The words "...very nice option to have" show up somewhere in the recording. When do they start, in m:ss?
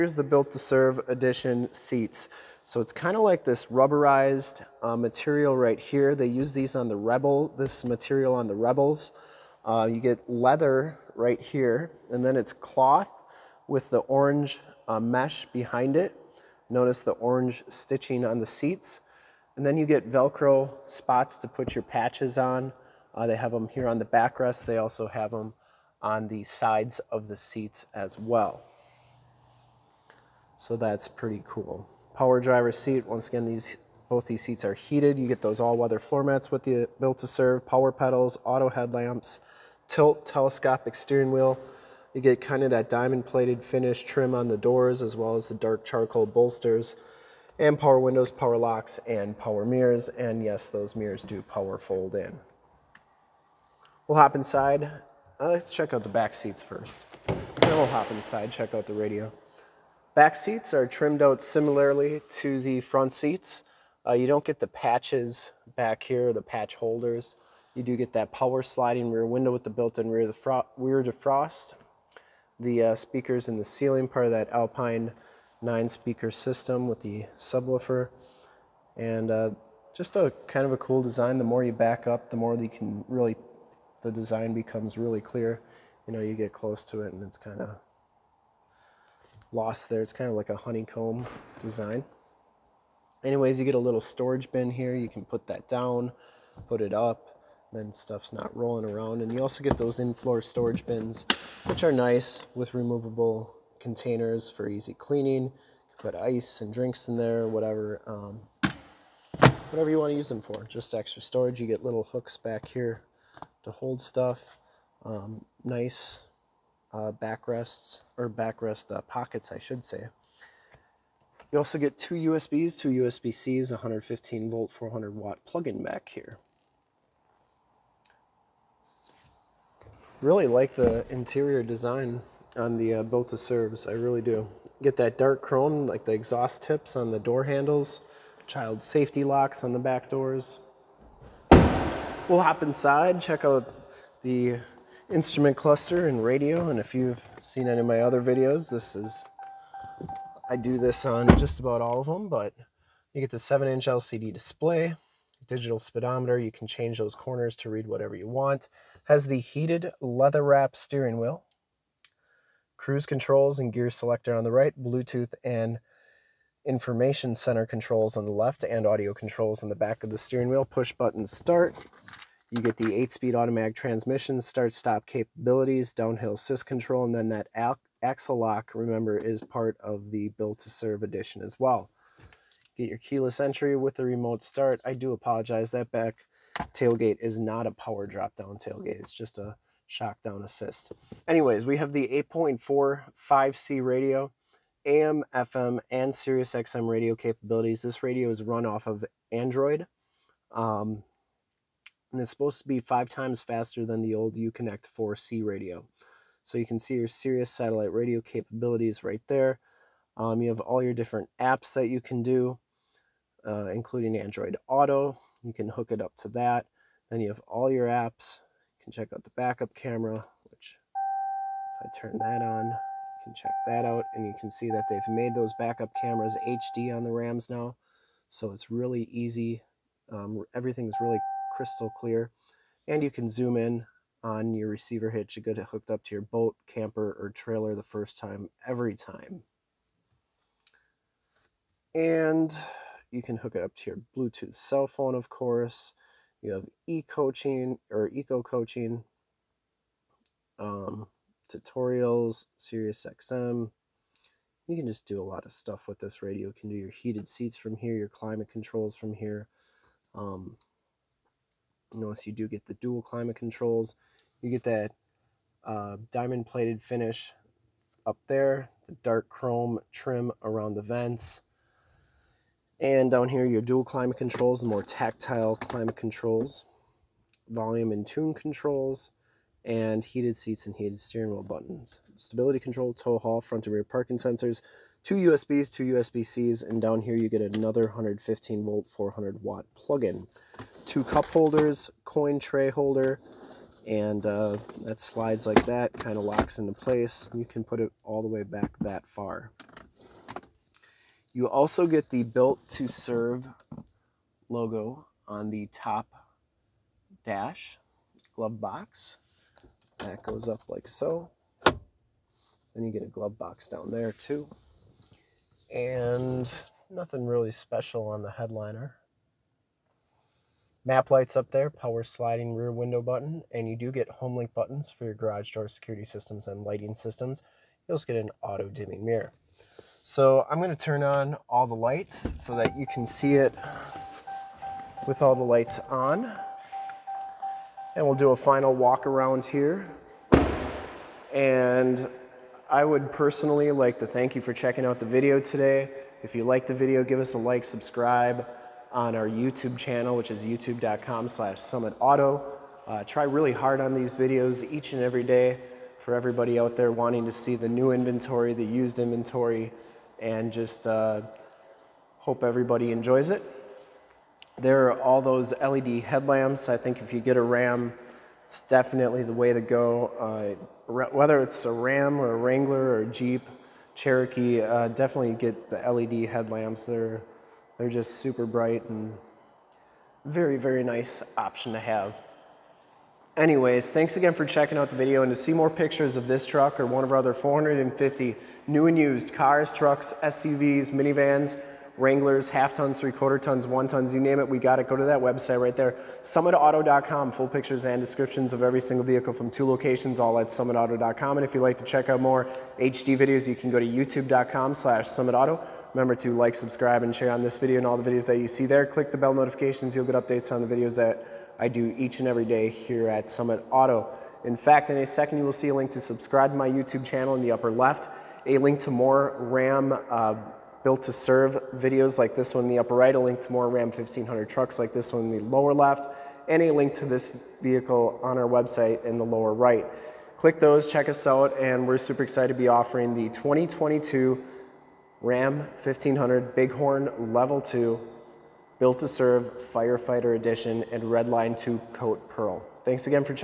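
6:20.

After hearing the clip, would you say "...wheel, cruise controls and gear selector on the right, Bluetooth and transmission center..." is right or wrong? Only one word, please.
wrong.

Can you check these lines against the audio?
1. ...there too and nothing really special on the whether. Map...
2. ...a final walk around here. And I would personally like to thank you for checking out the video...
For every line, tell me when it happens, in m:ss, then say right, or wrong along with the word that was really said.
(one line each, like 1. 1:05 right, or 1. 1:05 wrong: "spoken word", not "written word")
1. 5:13 wrong: "headliner", not "whether"
2. 5:38 right.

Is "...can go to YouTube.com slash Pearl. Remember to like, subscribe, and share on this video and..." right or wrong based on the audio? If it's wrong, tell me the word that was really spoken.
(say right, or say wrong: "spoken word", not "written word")
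wrong: "SummitAuto", not "Pearl".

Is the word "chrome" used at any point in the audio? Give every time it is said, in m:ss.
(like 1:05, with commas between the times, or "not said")
2:15, 4:29.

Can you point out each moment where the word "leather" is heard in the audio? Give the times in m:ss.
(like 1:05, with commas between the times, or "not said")
0:10, 2:39.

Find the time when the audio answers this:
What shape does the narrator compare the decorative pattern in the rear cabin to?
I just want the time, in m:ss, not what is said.
1:30.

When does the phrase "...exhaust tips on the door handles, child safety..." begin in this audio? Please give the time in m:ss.
2:16.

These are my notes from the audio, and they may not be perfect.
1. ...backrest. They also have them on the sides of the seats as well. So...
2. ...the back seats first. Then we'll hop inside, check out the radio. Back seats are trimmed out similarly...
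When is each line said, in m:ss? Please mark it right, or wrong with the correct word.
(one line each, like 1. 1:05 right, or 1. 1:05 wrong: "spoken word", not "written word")
1. 0:24 right
2. 0:56 right.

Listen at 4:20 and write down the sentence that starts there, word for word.
Um, Notice you do get the dual climate controls.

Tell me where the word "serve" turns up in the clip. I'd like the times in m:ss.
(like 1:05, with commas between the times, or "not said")
0:00, 0:37, 2:13, 3:00, 5:02, 7:01, 7:19.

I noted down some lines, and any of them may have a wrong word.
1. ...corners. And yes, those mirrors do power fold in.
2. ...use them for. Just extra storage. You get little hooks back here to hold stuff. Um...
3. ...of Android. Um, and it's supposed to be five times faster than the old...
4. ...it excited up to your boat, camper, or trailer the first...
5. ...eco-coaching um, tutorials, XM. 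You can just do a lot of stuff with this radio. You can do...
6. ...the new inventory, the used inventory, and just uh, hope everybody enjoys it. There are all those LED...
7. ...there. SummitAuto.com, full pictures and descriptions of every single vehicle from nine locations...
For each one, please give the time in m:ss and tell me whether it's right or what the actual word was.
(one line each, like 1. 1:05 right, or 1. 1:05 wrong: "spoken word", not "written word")
1. 0:49 wrong: "mirrors", not "corners"
2. 1:50 right
3. 3:18 right
4. 3:55 wrong: "hooked", not "excited"
5. 4:08 right
6. 5:57 right
7. 6:35 wrong: "two", not "nine".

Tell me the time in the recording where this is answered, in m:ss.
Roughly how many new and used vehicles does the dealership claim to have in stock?
6:27.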